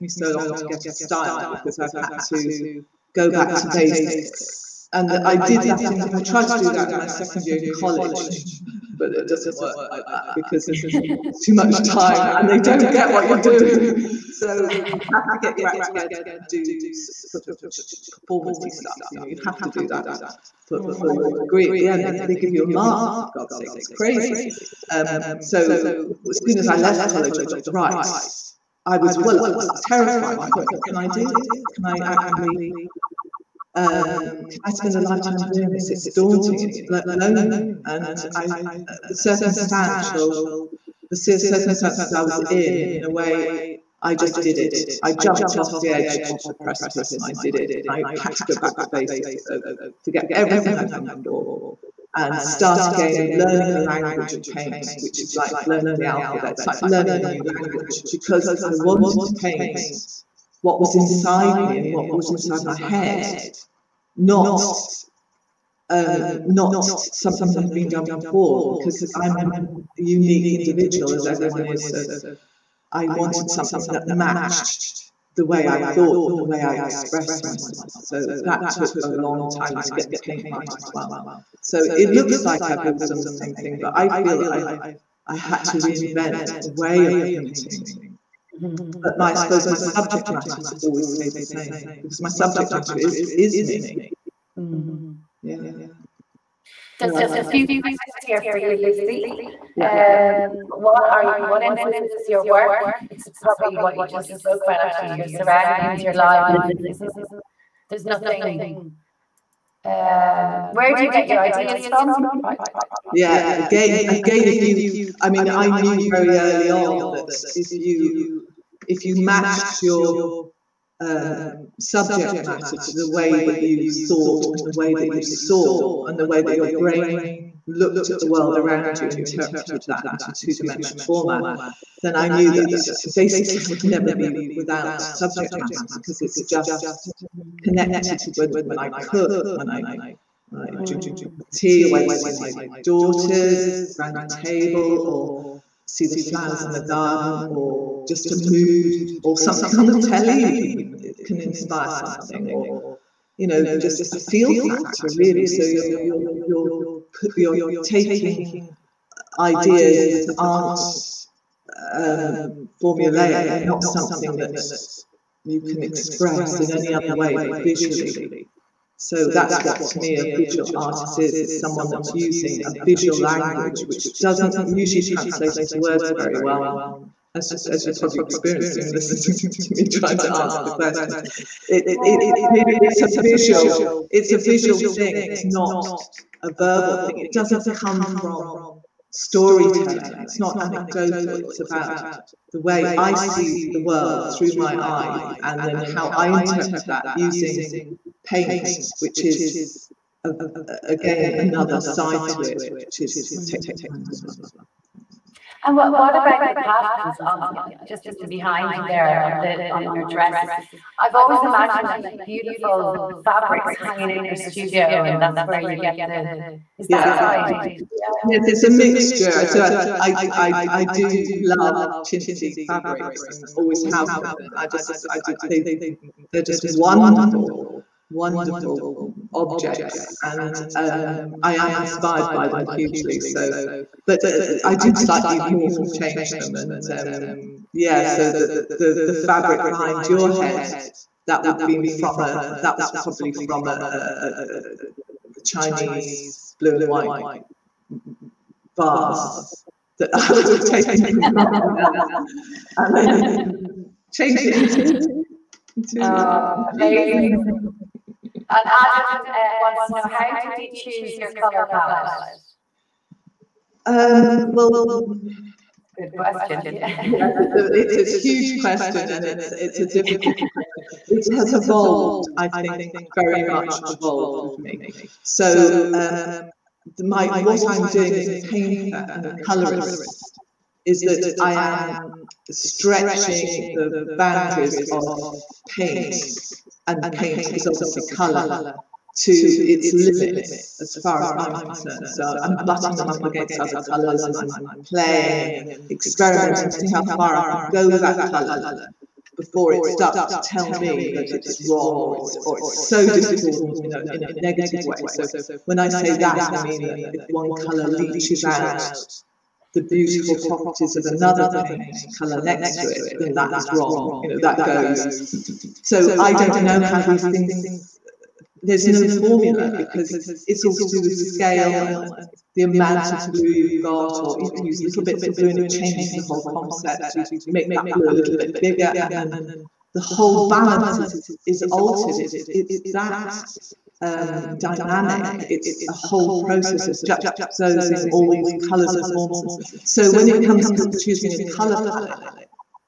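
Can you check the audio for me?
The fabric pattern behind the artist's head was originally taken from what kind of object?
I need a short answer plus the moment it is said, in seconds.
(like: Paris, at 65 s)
Chinese blue and white vase, at 245 s.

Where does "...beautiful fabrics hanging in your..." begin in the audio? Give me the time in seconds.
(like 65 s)
212 s.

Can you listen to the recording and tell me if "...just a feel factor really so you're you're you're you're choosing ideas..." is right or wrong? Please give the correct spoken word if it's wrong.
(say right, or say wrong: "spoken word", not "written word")
wrong: "taking", not "choosing".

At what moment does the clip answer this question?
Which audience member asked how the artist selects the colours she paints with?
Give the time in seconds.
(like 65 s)
258 s.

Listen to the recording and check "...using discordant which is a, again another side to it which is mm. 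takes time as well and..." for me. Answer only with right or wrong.
wrong.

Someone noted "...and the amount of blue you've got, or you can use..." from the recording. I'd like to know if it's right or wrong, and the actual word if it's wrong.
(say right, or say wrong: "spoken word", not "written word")
right.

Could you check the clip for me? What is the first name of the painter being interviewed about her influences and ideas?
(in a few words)
Lucy.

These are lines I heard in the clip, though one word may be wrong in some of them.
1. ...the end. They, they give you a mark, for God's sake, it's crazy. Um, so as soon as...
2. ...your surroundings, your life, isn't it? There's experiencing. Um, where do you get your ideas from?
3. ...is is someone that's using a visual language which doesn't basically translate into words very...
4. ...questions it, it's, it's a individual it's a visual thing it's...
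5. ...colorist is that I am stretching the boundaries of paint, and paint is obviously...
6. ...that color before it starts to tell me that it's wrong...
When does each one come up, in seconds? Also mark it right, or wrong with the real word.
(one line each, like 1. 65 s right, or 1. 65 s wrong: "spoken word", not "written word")
1. 21 s right
2. 105 s wrong: "nothing", not "experiencing"
3. 171 s wrong: "usually", not "basically"
4. 180 s wrong: "visual", not "individual"
5. 279 s right
6. 298 s right.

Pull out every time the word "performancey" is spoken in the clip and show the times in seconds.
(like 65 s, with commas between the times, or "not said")
18 s.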